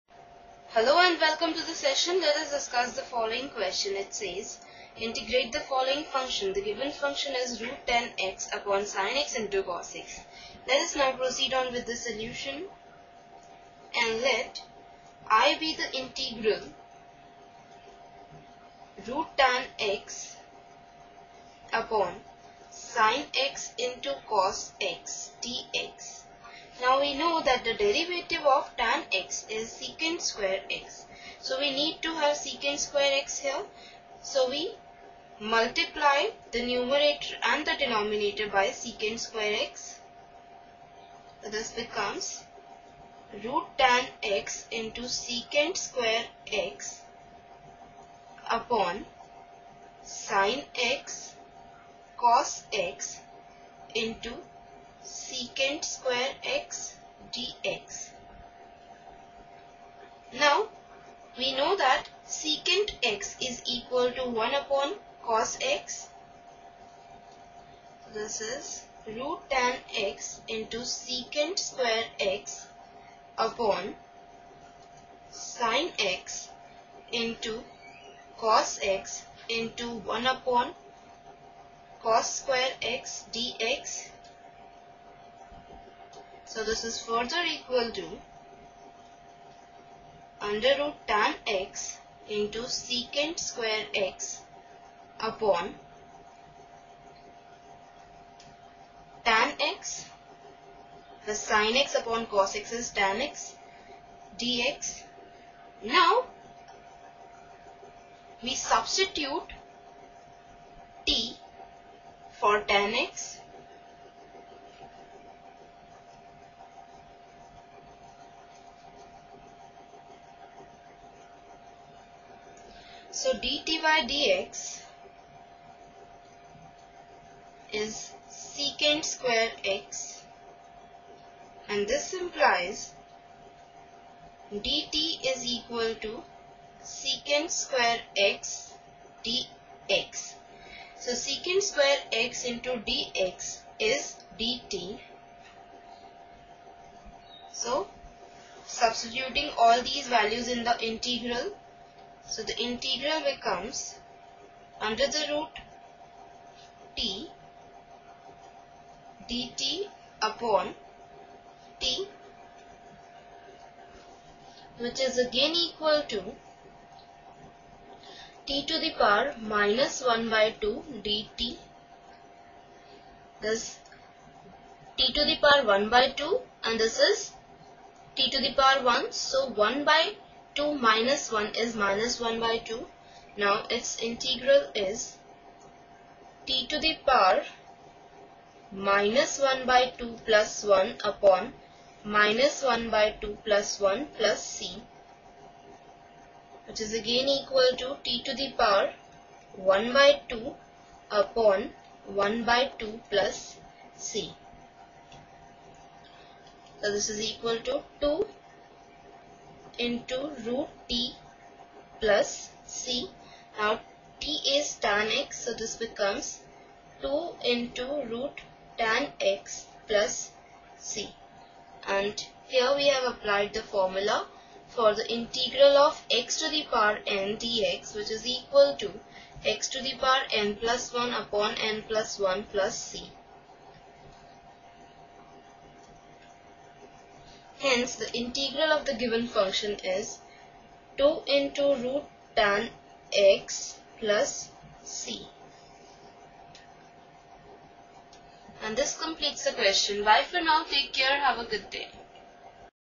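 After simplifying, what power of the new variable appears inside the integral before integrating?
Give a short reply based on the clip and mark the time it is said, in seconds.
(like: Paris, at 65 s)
-1/2, at 168 s.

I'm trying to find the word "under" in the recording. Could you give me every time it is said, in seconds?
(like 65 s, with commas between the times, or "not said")
90 s, 154 s.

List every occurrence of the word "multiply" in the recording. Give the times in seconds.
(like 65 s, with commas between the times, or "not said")
35 s.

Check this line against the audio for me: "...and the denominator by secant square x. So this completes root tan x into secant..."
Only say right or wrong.
wrong.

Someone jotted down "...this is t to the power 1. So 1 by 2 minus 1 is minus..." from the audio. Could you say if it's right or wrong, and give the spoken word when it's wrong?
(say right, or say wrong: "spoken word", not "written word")
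right.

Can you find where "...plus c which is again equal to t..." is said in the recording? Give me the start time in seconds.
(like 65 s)
194 s.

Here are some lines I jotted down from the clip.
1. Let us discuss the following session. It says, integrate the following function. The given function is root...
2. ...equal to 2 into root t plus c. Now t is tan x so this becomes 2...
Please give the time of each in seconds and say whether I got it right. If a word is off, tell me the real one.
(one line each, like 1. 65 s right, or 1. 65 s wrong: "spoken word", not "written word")
1. 2 s wrong: "question", not "session"
2. 207 s right.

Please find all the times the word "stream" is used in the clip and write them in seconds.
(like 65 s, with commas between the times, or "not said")
not said.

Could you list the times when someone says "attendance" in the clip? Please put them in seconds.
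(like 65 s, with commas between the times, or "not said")
not said.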